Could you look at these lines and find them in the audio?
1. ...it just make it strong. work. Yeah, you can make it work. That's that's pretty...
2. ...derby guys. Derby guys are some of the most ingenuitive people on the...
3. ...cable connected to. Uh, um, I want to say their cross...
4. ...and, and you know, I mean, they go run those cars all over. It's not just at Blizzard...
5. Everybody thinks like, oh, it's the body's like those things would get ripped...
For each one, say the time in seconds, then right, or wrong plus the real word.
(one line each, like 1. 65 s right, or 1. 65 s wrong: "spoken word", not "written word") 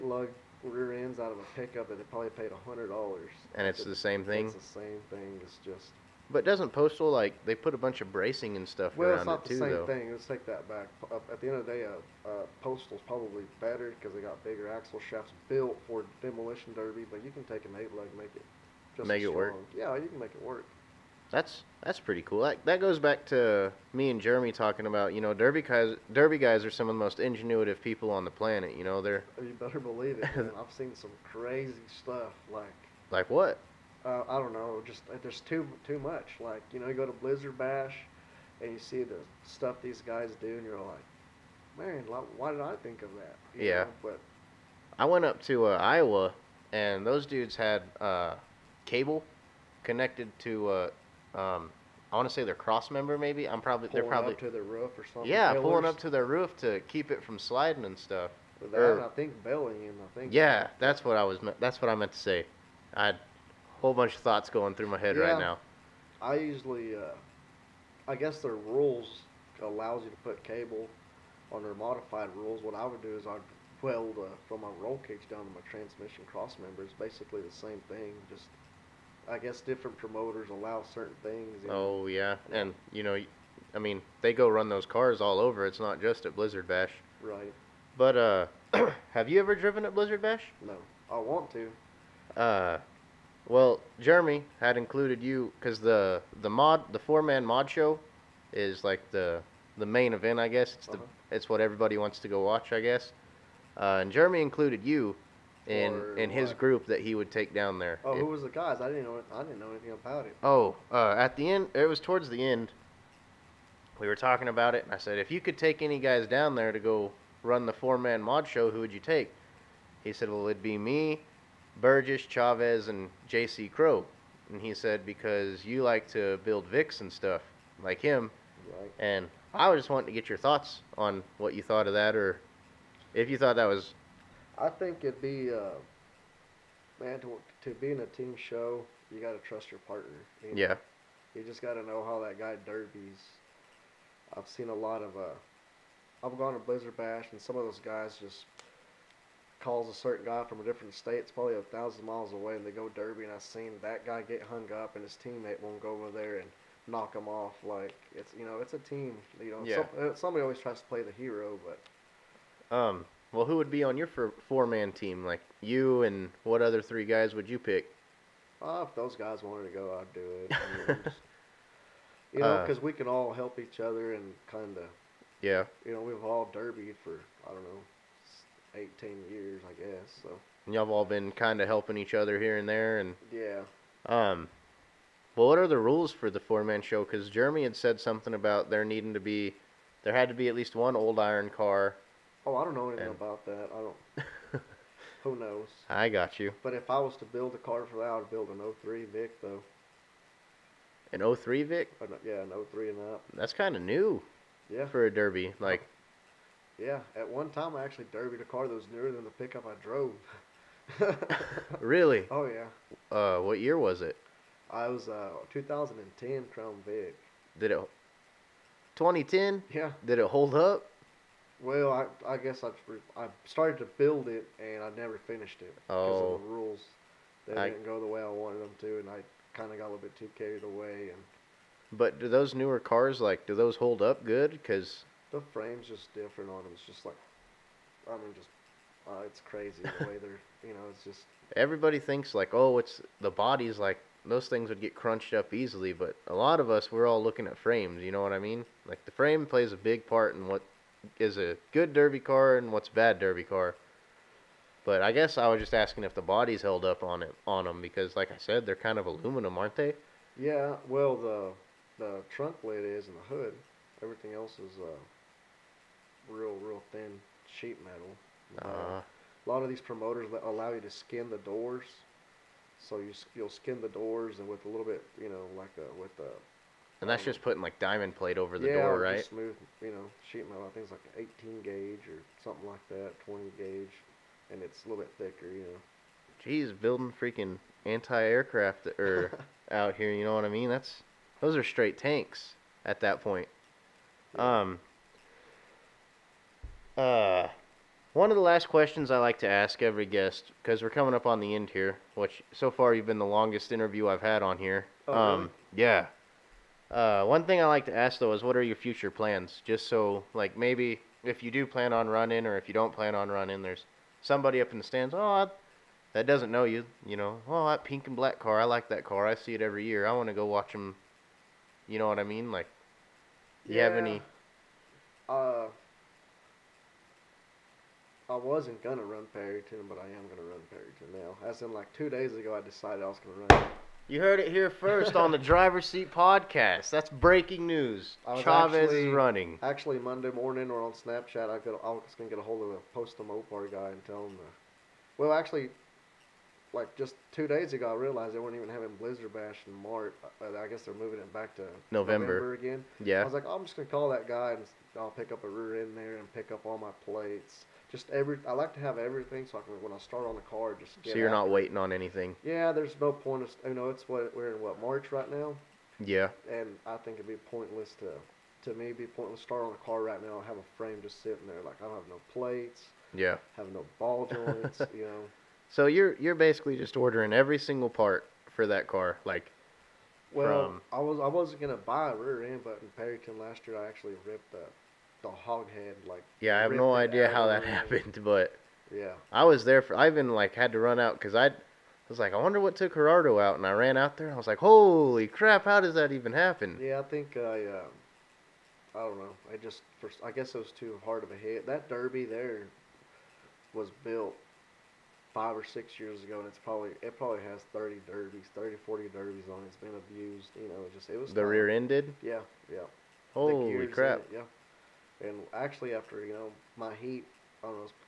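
1. 18 s right
2. 25 s right
3. 48 s right
4. 82 s right
5. 241 s wrong: "crunched", not "ripped".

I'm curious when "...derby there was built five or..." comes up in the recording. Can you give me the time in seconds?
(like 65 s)
401 s.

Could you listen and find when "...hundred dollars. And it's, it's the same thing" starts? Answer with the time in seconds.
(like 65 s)
2 s.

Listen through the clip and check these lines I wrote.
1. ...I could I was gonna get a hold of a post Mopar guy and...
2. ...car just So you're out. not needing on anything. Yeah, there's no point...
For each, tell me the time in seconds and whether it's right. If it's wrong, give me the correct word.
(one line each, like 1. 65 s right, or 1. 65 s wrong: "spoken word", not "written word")
1. 341 s right
2. 360 s wrong: "waiting", not "needing".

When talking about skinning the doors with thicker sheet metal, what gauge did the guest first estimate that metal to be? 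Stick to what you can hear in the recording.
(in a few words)
18 gauge.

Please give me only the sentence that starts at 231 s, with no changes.
But do those newer cars like do those hold up good?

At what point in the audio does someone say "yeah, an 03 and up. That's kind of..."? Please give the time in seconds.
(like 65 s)
202 s.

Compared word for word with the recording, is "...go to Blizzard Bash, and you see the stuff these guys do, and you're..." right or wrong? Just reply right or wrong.
right.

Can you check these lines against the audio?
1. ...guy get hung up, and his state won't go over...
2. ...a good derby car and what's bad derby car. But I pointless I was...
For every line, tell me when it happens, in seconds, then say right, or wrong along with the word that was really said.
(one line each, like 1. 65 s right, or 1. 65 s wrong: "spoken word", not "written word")
1. 154 s wrong: "teammate", not "state"
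2. 251 s wrong: "guess", not "pointless".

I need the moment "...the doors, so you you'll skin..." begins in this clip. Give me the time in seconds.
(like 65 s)
271 s.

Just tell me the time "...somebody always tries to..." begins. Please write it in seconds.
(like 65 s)
160 s.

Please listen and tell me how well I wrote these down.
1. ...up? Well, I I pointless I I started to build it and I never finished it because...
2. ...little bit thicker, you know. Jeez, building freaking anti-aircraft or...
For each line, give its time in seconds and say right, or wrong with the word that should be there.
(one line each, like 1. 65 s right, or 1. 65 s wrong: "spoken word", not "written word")
1. 220 s wrong: "guess", not "pointless"
2. 284 s right.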